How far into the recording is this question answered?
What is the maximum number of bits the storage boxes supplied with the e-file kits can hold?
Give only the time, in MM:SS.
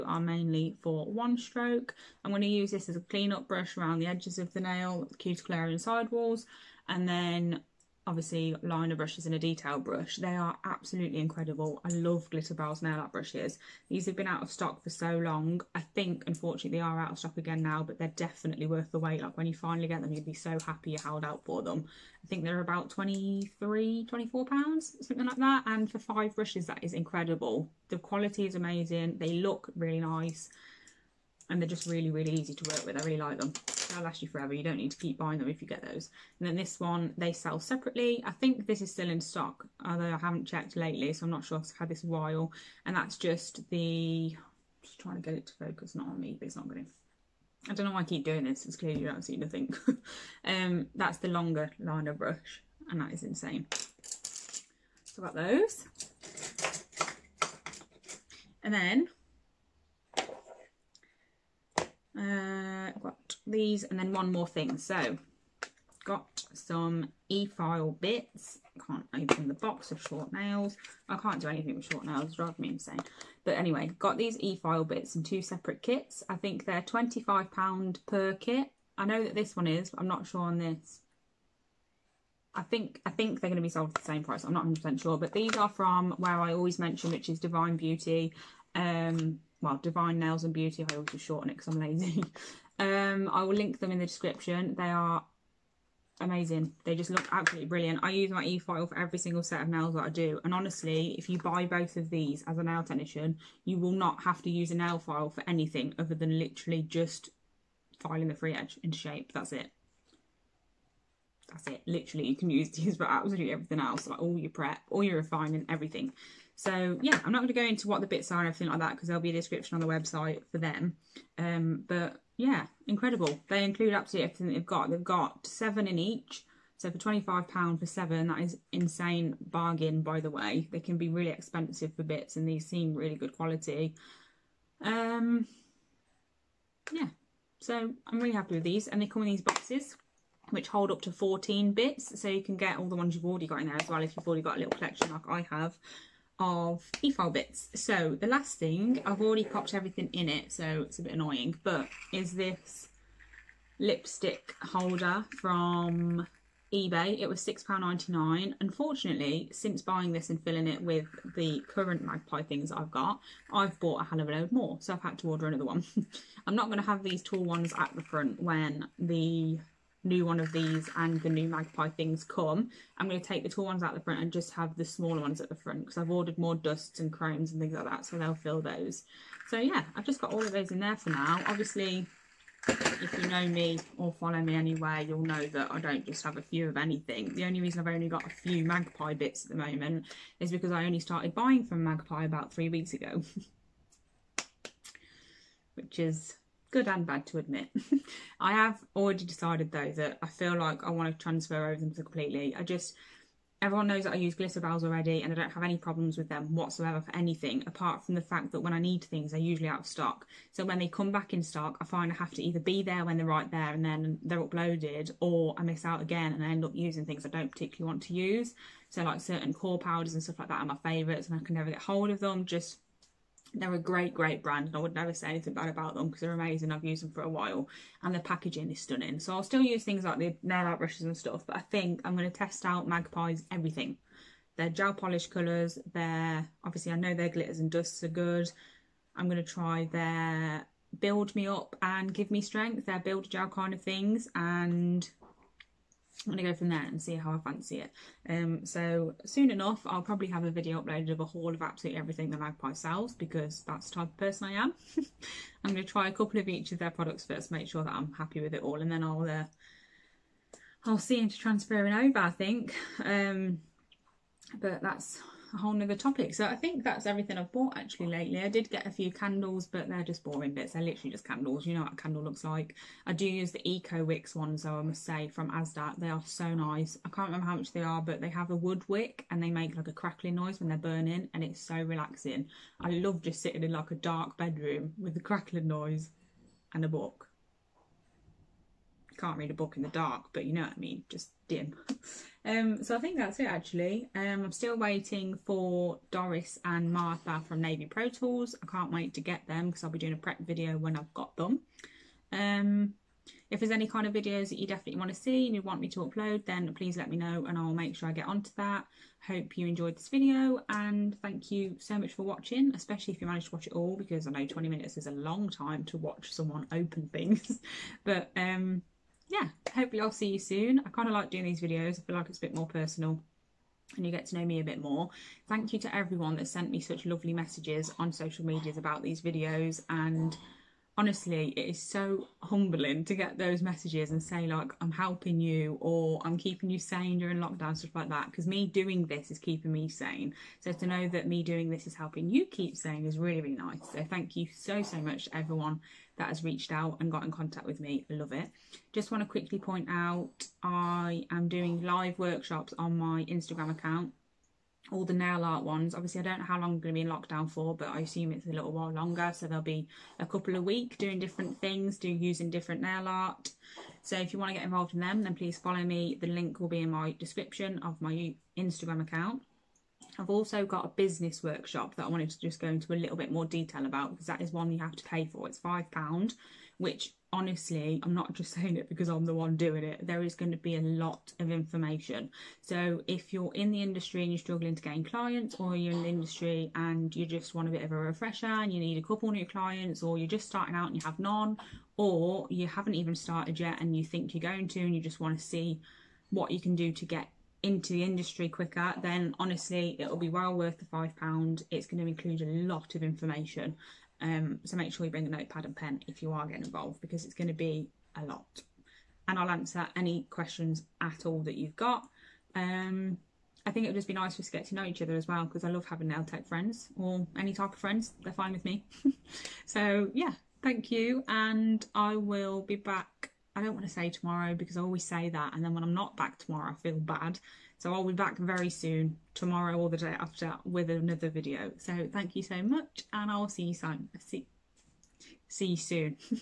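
02:21.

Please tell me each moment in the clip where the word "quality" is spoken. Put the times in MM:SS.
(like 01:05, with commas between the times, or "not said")
00:27, 02:13.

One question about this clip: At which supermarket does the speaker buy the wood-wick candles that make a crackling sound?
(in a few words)
Asda.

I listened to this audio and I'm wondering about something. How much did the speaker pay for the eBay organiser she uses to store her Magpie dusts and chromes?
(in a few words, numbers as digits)
£6.99.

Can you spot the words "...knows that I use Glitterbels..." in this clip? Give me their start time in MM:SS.
03:23.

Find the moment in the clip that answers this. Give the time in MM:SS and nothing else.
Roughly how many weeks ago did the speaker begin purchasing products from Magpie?
03:12.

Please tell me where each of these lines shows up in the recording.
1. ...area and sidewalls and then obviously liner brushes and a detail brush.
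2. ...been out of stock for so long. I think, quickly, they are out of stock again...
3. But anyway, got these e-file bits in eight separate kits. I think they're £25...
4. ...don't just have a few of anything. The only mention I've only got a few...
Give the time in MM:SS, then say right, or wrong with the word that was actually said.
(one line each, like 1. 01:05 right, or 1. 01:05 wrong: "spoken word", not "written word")
1. 00:05 right
2. 00:14 wrong: "unfortunately", not "quickly"
3. 01:13 wrong: "two", not "eight"
4. 03:05 wrong: "reason", not "mention".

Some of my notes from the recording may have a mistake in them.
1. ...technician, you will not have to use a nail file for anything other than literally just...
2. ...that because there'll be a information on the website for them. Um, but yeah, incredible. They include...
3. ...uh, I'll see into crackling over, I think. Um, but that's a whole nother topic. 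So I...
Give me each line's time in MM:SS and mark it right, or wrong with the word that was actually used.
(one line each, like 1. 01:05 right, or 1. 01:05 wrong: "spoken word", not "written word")
1. 01:42 right
2. 01:58 wrong: "description", not "information"
3. 04:19 wrong: "transferring", not "crackling".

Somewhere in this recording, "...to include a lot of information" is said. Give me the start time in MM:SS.
06:42.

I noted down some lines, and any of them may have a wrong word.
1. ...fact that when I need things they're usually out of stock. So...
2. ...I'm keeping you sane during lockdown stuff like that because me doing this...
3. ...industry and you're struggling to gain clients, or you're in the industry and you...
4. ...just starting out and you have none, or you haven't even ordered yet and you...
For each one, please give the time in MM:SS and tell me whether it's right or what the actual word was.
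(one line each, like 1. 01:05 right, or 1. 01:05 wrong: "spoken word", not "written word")
1. 03:28 right
2. 05:36 right
3. 06:23 right
4. 06:30 wrong: "started", not "ordered".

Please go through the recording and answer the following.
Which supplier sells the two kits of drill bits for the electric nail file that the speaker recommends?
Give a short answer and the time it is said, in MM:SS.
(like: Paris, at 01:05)
Divine Nails and Beauty, at 01:29.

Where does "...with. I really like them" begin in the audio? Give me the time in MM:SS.
00:32.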